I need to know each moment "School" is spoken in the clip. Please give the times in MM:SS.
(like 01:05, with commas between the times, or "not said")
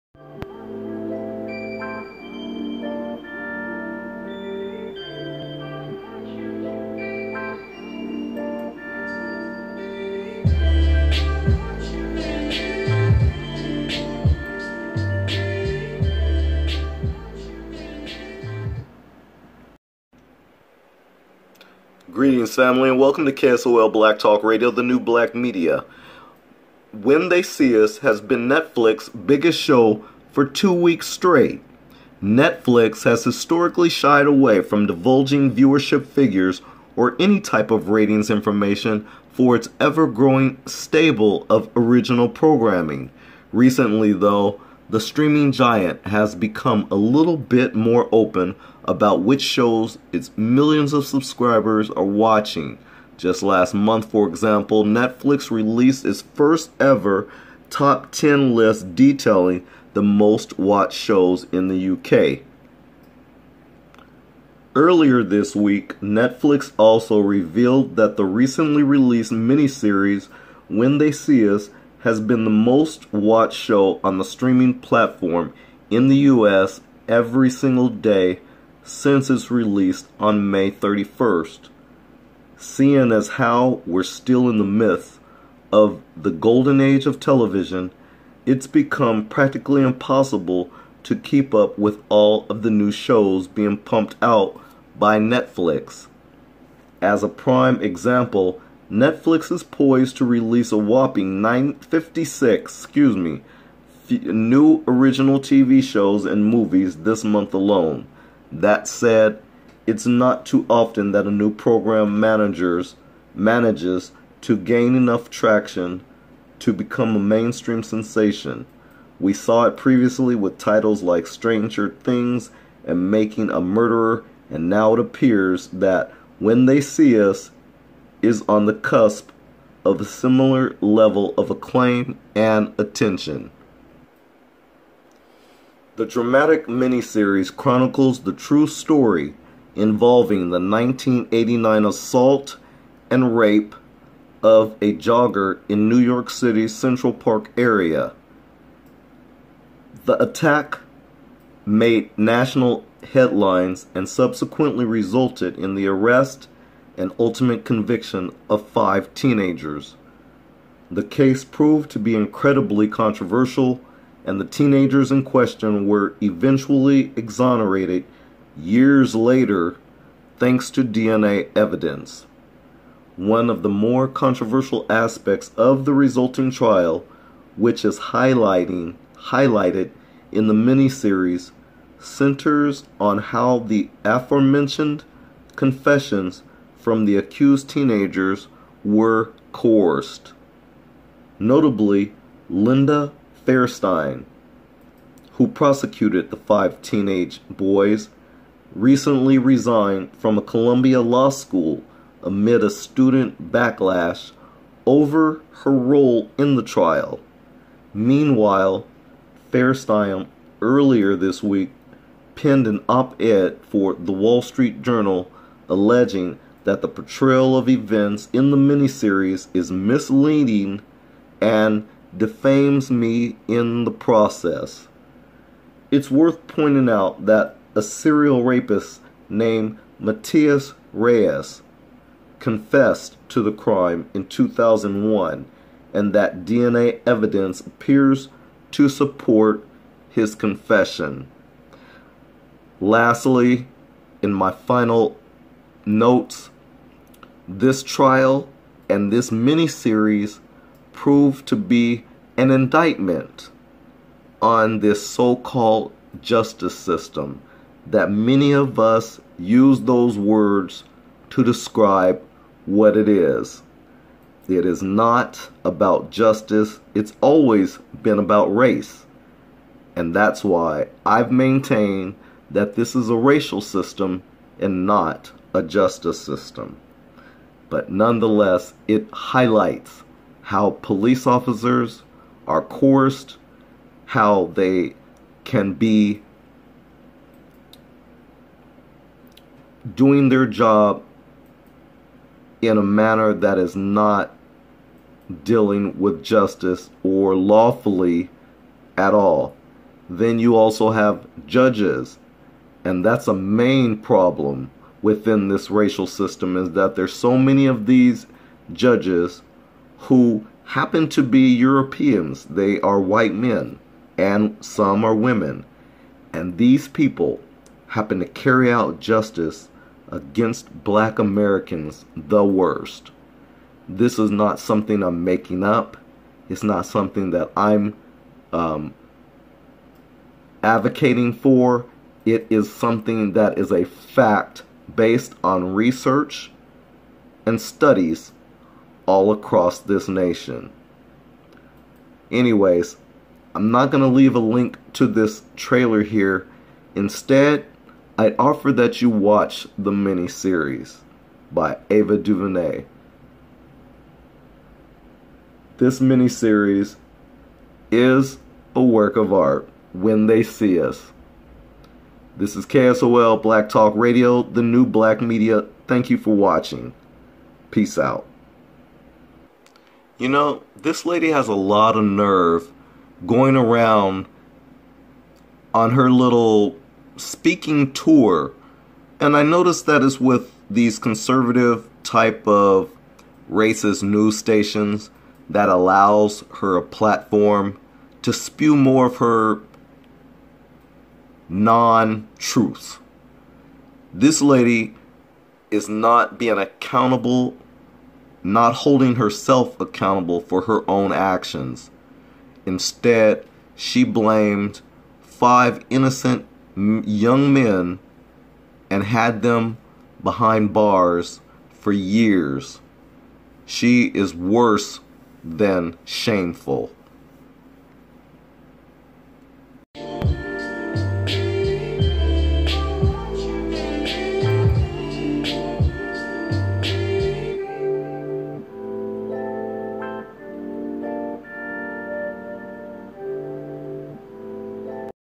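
03:21.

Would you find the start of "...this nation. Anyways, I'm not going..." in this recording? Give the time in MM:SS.
05:39.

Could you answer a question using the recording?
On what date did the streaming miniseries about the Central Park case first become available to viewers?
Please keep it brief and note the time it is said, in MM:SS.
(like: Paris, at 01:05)
May 31st, at 01:20.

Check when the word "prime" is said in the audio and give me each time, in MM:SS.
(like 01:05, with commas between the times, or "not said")
01:37.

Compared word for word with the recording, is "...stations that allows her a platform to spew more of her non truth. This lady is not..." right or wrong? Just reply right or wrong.
right.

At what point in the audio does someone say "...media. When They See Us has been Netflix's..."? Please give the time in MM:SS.
00:25.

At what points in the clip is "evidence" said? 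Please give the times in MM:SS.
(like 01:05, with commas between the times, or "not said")
02:51, 03:57.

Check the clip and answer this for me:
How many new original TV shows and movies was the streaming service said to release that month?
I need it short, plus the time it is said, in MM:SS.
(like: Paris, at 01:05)
956, at 01:41.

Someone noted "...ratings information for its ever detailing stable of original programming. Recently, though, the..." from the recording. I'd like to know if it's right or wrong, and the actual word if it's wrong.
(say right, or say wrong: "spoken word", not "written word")
wrong: "growing", not "detailing".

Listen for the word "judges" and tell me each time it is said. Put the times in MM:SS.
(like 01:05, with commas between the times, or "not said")
05:01, 05:08.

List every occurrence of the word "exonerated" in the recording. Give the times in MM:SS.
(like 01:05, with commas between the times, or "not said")
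02:47.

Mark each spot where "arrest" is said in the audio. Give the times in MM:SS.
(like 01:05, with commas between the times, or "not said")
02:35.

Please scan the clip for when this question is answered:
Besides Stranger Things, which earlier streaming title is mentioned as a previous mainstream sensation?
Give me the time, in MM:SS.
02:03.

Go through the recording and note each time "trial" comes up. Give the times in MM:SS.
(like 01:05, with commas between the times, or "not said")
02:56, 03:26, 04:07.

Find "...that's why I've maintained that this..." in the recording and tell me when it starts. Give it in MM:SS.
04:30.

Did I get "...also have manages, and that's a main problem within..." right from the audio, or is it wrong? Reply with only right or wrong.
wrong.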